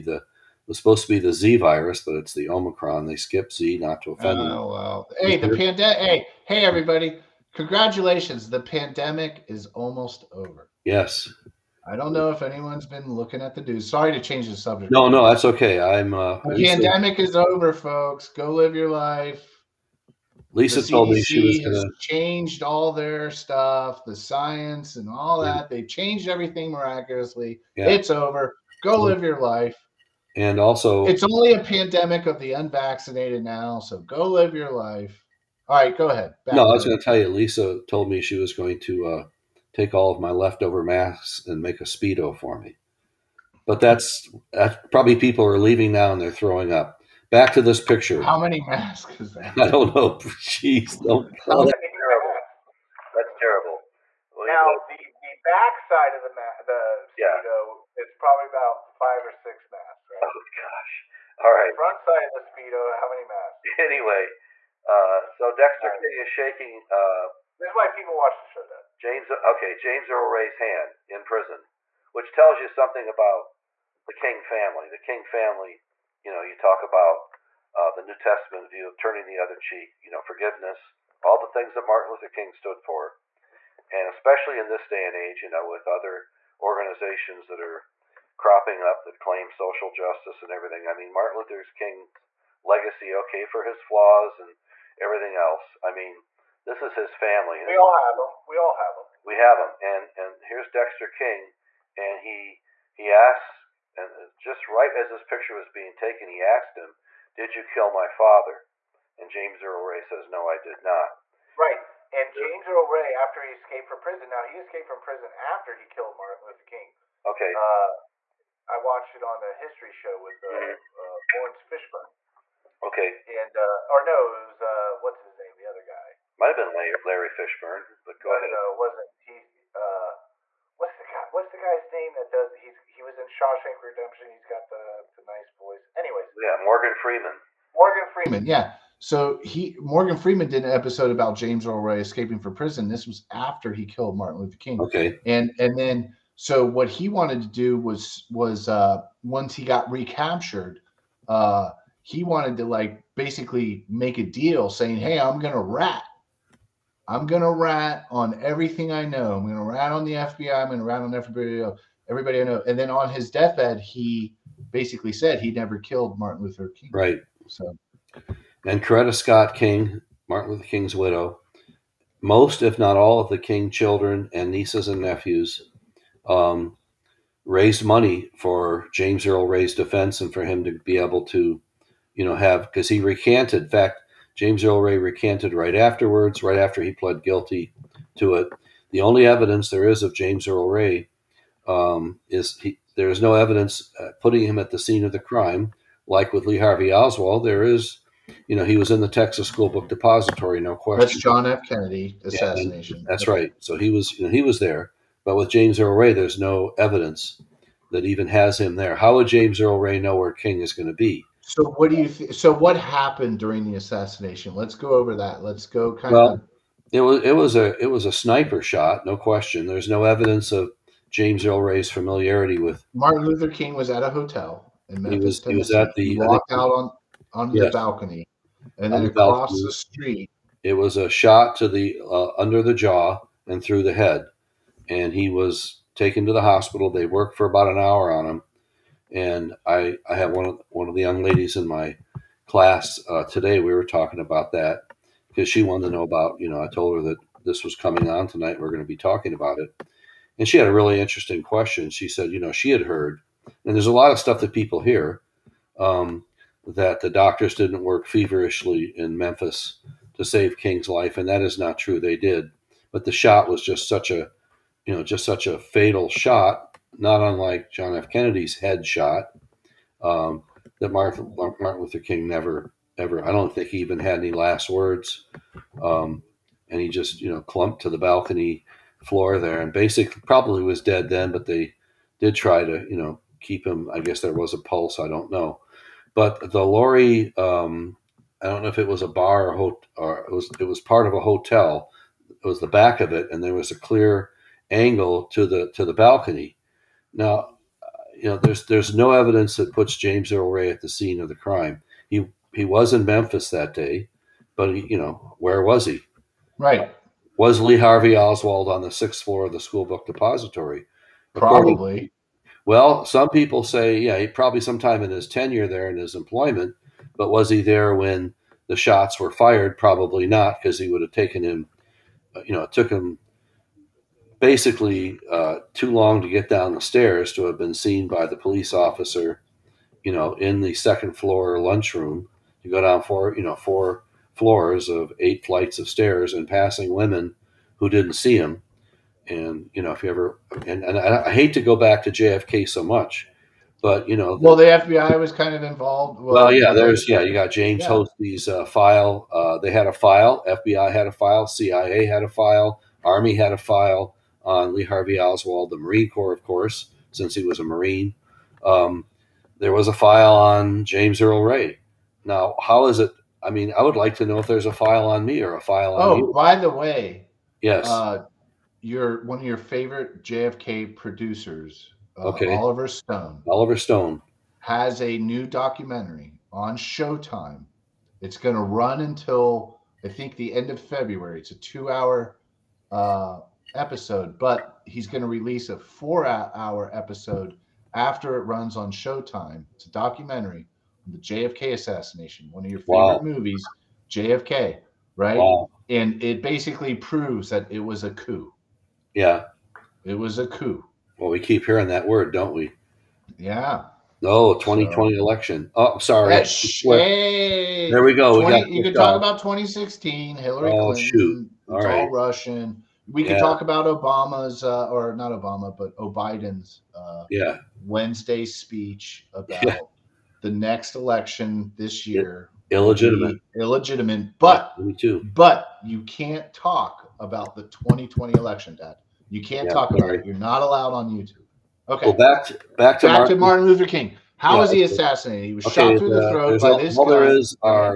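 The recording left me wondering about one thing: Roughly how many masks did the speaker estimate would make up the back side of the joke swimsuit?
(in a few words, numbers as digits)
5 or 6.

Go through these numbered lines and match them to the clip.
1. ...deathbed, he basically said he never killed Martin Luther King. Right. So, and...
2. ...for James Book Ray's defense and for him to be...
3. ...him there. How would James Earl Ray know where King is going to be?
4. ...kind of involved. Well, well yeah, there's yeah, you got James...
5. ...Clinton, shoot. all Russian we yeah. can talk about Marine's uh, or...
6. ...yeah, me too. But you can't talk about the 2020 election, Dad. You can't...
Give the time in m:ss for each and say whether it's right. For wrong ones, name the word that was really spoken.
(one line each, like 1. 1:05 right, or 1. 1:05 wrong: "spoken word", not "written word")
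1. 2:43 right
2. 2:58 wrong: "Earl", not "Book"
3. 3:28 right
4. 5:45 right
5. 6:50 wrong: "Obama", not "Marine"
6. 7:04 right.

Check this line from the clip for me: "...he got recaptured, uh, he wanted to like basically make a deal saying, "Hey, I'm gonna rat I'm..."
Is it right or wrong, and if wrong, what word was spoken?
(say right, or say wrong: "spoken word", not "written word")
right.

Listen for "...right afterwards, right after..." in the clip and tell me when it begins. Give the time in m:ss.
3:05.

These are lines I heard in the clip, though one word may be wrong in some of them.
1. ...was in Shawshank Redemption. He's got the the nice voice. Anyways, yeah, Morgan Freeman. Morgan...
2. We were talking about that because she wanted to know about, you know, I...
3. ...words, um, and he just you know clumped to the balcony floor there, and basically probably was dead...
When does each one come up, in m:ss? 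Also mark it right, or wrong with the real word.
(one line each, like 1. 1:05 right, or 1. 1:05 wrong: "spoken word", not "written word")
1. 2:13 right
2. 4:03 right
3. 4:34 right.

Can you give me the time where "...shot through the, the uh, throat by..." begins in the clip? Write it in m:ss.
7:15.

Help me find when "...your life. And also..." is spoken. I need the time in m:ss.
0:29.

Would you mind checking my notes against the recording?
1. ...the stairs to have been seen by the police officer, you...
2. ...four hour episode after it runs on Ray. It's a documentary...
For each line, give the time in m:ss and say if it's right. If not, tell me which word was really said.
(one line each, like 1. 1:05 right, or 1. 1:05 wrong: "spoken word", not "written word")
1. 5:26 right
2. 6:25 wrong: "Showtime", not "Ray".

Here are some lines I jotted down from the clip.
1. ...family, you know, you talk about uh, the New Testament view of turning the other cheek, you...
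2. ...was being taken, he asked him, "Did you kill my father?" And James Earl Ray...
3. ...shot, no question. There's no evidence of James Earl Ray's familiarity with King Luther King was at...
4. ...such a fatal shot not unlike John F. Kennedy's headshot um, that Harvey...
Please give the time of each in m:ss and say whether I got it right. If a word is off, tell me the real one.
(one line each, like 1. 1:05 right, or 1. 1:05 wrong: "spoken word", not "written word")
1. 1:15 right
2. 1:45 right
3. 3:38 wrong: "Martin", not "King"
4. 4:25 wrong: "Martin", not "Harvey".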